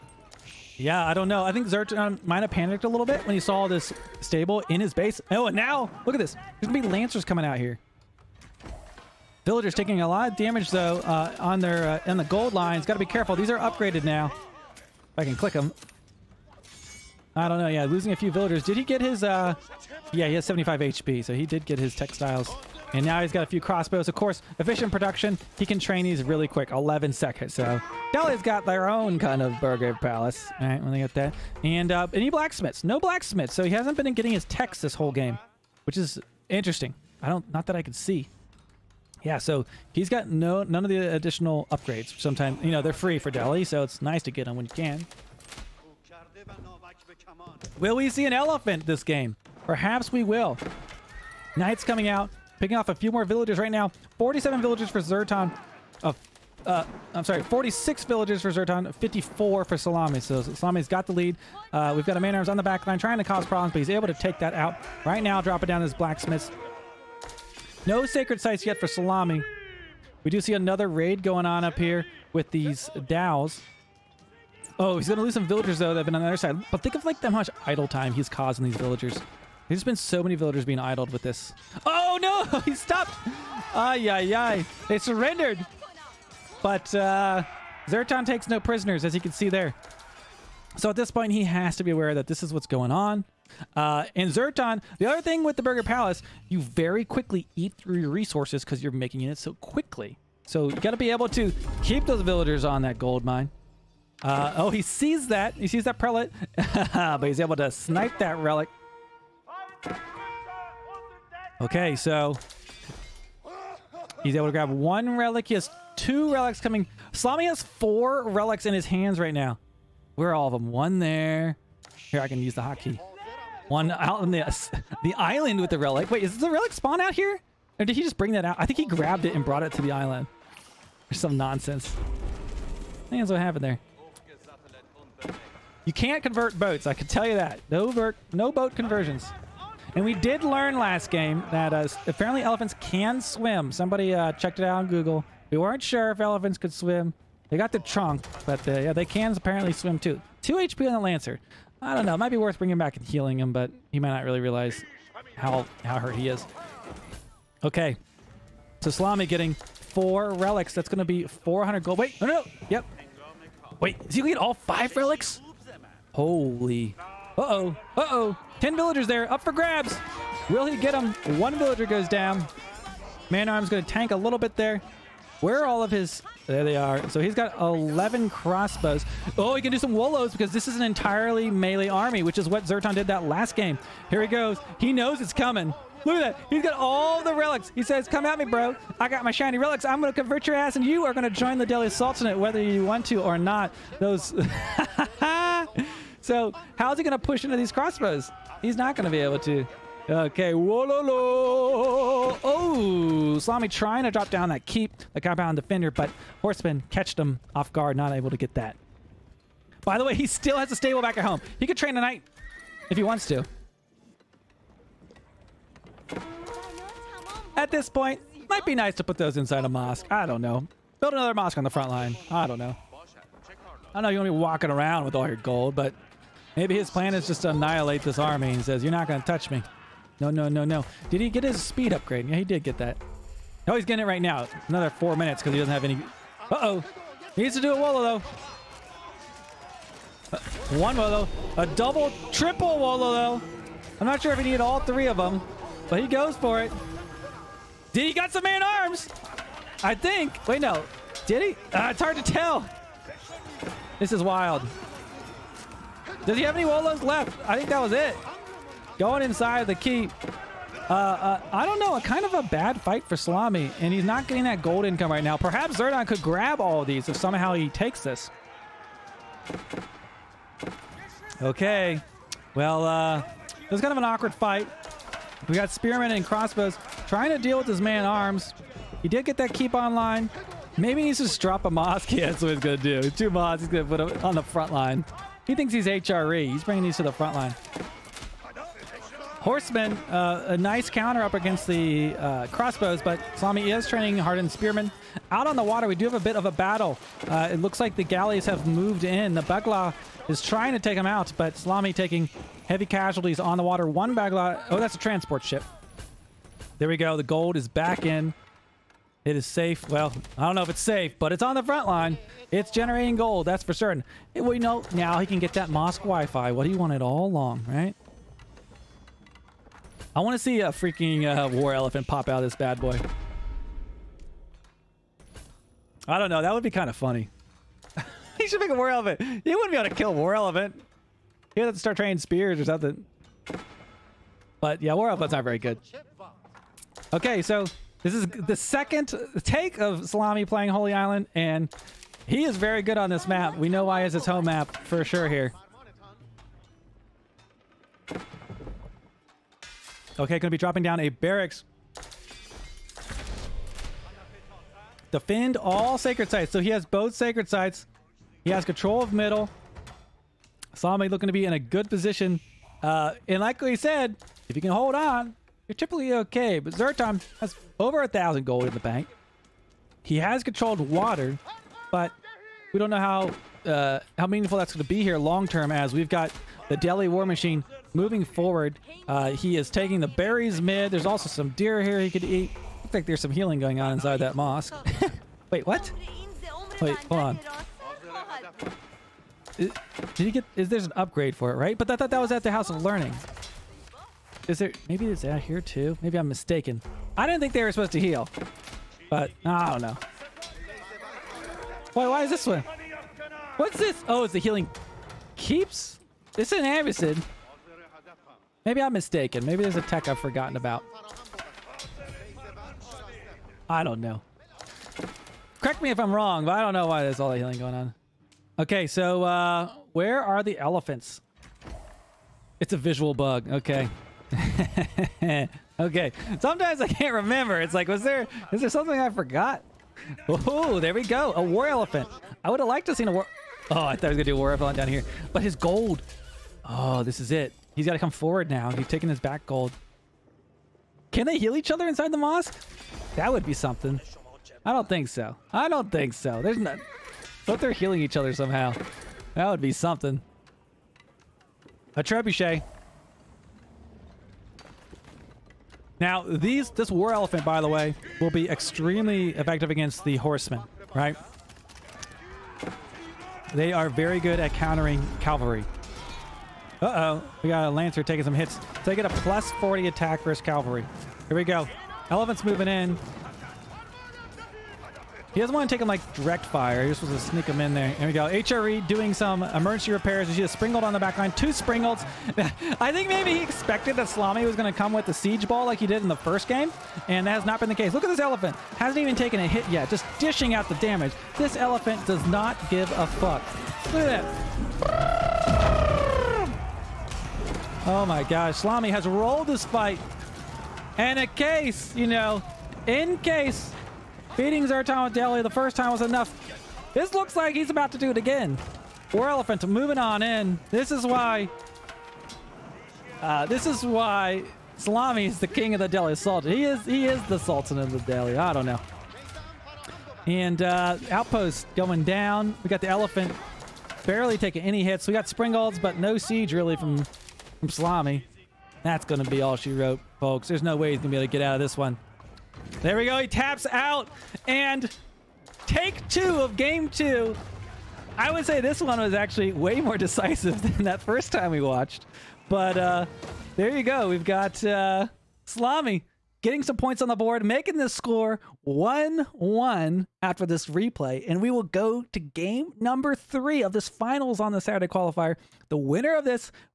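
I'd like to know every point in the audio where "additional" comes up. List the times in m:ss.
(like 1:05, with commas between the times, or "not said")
0:41.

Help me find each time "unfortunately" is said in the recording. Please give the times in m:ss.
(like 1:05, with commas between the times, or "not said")
not said.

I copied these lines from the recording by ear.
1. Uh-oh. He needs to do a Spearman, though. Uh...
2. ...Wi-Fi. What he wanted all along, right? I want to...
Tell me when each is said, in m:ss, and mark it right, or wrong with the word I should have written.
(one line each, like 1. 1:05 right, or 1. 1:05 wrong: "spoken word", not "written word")
1. 3:56 wrong: "Wolo", not "Spearman"
2. 5:16 right.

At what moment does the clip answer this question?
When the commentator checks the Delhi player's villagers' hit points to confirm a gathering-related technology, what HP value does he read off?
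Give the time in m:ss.
0:20.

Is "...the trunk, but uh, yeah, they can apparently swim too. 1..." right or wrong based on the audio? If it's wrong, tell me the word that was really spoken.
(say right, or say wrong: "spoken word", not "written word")
wrong: "2", not "1".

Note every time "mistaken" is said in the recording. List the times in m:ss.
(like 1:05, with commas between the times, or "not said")
6:36, 6:48.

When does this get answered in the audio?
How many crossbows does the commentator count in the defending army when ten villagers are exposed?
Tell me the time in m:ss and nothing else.
2:57.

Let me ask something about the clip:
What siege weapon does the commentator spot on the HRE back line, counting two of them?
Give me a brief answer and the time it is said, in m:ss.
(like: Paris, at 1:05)
Springald, at 8:00.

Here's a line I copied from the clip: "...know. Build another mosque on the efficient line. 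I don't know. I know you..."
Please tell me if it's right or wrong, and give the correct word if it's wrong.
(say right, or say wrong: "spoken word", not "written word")
wrong: "front", not "efficient".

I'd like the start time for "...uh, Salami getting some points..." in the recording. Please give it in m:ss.
9:04.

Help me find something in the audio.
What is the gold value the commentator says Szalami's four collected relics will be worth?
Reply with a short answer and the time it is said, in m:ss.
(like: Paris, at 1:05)
400 gold, at 2:41.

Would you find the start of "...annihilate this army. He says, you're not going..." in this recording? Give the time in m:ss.
3:47.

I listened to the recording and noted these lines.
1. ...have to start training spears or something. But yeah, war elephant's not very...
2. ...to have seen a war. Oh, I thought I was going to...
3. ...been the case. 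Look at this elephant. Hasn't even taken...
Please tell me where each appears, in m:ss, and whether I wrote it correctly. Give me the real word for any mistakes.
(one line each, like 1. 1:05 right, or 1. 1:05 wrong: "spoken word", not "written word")
1. 5:31 right
2. 7:12 right
3. 8:07 right.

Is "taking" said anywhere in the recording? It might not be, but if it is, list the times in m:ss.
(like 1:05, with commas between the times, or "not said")
0:09, 5:01, 6:19, 7:18, 7:48, 8:44.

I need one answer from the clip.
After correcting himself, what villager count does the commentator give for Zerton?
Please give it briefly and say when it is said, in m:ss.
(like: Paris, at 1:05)
46, at 0:57.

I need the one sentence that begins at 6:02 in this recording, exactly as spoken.
Uh, and like we said, if you can hold on, you're typically okay.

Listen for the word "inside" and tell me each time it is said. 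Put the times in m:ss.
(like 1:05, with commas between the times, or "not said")
3:39, 4:19, 6:23, 7:21.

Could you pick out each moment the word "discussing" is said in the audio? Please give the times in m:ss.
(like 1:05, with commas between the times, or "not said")
not said.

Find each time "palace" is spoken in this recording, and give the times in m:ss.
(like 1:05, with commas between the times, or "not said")
0:30, 1:35.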